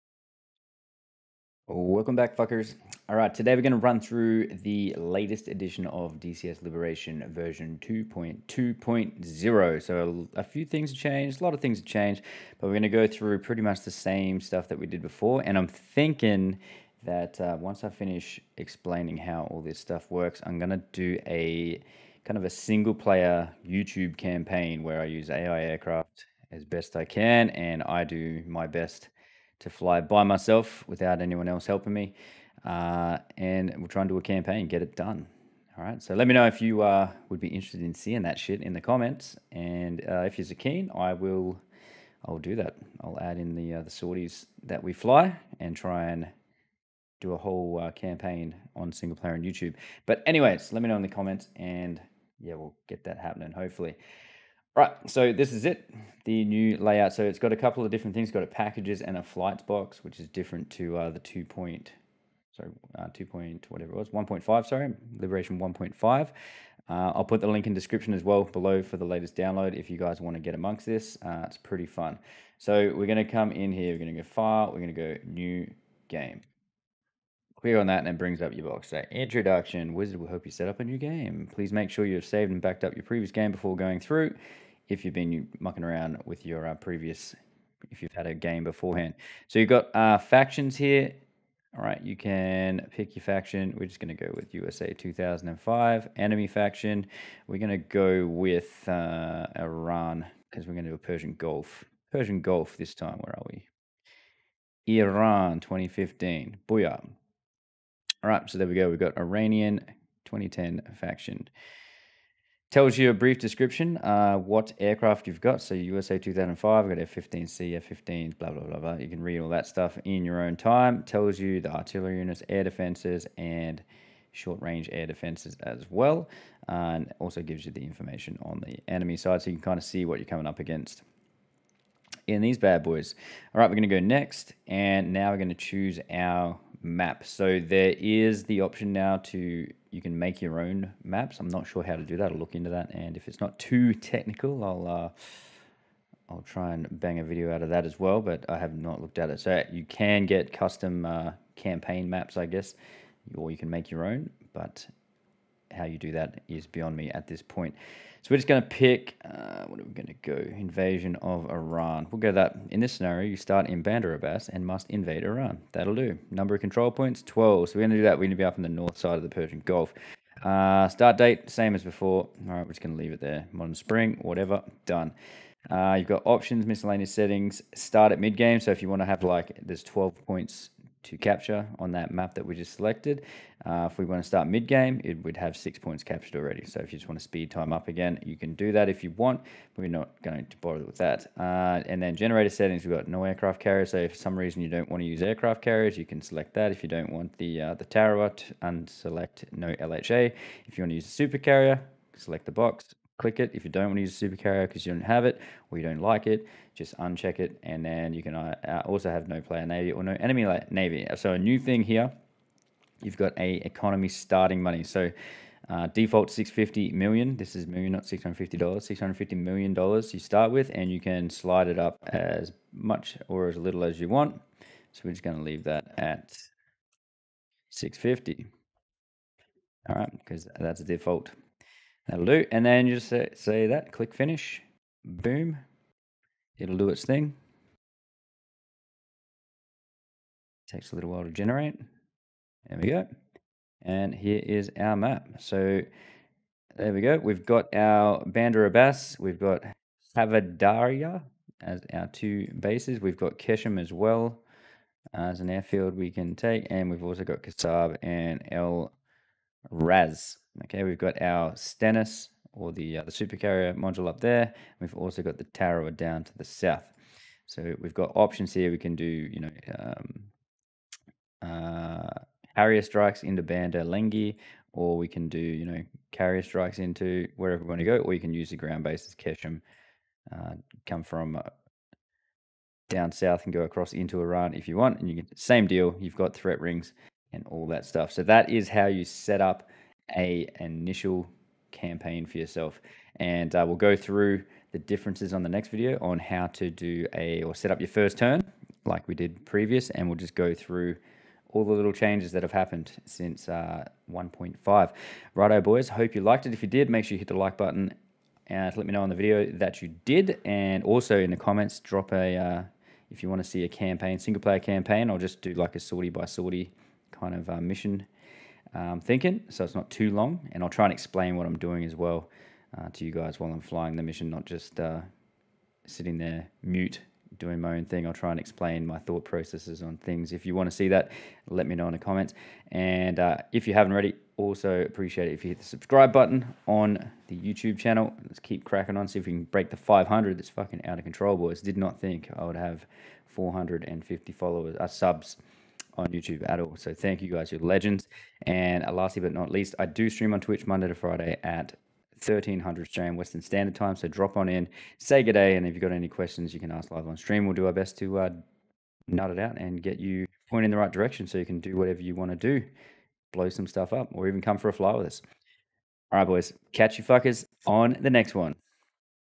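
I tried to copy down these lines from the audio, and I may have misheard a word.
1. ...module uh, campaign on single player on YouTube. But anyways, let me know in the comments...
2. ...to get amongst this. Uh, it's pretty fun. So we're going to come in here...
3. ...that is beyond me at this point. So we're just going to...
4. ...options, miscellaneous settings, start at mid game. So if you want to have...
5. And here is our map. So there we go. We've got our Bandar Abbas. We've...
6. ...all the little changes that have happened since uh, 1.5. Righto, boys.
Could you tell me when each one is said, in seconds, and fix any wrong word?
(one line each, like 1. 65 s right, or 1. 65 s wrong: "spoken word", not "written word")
1. 47 s wrong: "whole", not "module"
2. 70 s right
3. 156 s right
4. 176 s right
5. 243 s right
6. 301 s right.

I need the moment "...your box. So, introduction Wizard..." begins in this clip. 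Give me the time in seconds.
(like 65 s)
78 s.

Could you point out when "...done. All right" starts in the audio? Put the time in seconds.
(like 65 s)
34 s.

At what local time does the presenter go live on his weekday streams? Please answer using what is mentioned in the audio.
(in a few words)
1300.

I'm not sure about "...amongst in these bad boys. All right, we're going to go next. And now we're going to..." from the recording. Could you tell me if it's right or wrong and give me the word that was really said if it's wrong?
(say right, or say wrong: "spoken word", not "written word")
wrong: "against", not "amongst".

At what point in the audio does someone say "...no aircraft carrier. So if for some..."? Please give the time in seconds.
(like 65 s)
193 s.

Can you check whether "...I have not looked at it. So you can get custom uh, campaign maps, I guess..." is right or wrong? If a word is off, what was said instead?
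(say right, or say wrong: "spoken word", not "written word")
right.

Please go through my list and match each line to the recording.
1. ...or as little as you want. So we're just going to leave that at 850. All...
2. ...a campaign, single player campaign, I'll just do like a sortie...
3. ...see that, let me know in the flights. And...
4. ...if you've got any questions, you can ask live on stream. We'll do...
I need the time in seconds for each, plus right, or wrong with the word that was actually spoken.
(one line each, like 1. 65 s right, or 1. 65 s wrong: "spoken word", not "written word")
1. 223 s wrong: "650", not "850"
2. 313 s right
3. 330 s wrong: "comments", not "flights"
4. 355 s right.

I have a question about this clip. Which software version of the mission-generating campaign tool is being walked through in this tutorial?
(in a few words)
2.2.0.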